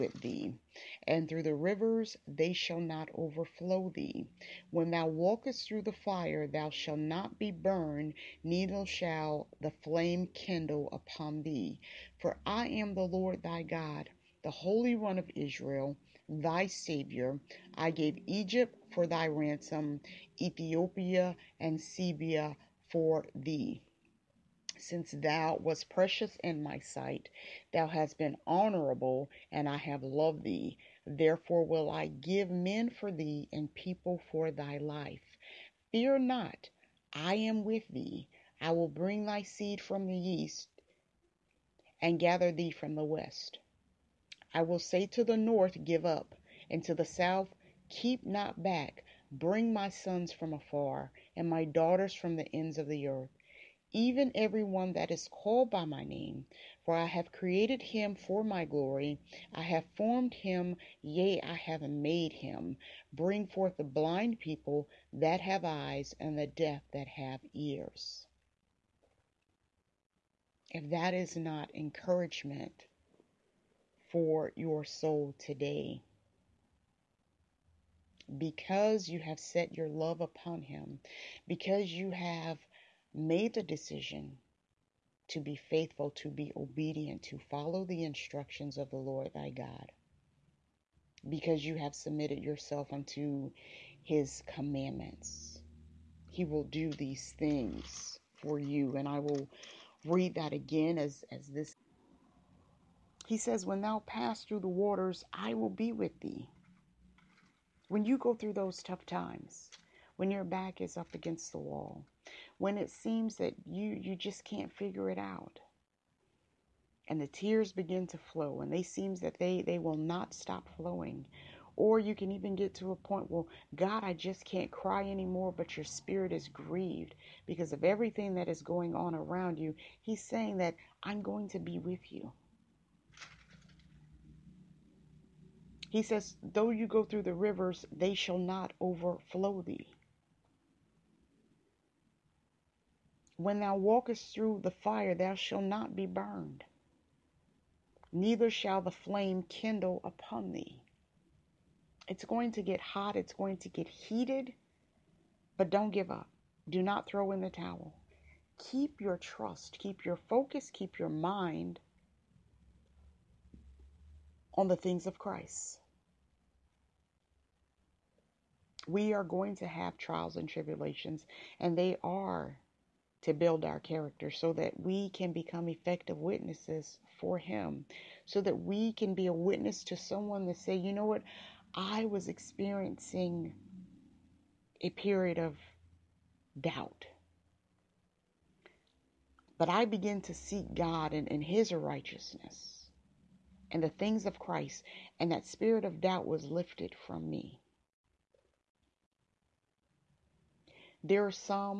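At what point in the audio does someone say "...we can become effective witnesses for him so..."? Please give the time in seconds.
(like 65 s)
174 s.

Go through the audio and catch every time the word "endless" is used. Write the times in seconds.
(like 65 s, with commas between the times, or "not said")
not said.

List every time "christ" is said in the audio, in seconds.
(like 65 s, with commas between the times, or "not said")
165 s, 194 s.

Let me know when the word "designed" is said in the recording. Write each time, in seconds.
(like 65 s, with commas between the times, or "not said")
not said.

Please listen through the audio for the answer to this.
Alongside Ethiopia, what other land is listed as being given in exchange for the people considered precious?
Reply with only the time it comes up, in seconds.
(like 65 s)
21 s.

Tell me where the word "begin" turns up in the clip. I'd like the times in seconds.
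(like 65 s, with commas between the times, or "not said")
117 s, 189 s.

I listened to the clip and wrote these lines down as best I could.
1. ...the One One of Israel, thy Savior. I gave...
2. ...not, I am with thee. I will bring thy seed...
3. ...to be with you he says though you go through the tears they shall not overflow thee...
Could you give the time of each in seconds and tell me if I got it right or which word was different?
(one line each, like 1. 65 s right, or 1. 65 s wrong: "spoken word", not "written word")
1. 14 s wrong: "Holy", not "One"
2. 36 s right
3. 131 s wrong: "rivers", not "tears".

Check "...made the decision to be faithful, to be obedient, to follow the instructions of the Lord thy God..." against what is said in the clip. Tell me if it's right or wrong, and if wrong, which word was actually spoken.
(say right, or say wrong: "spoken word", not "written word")
right.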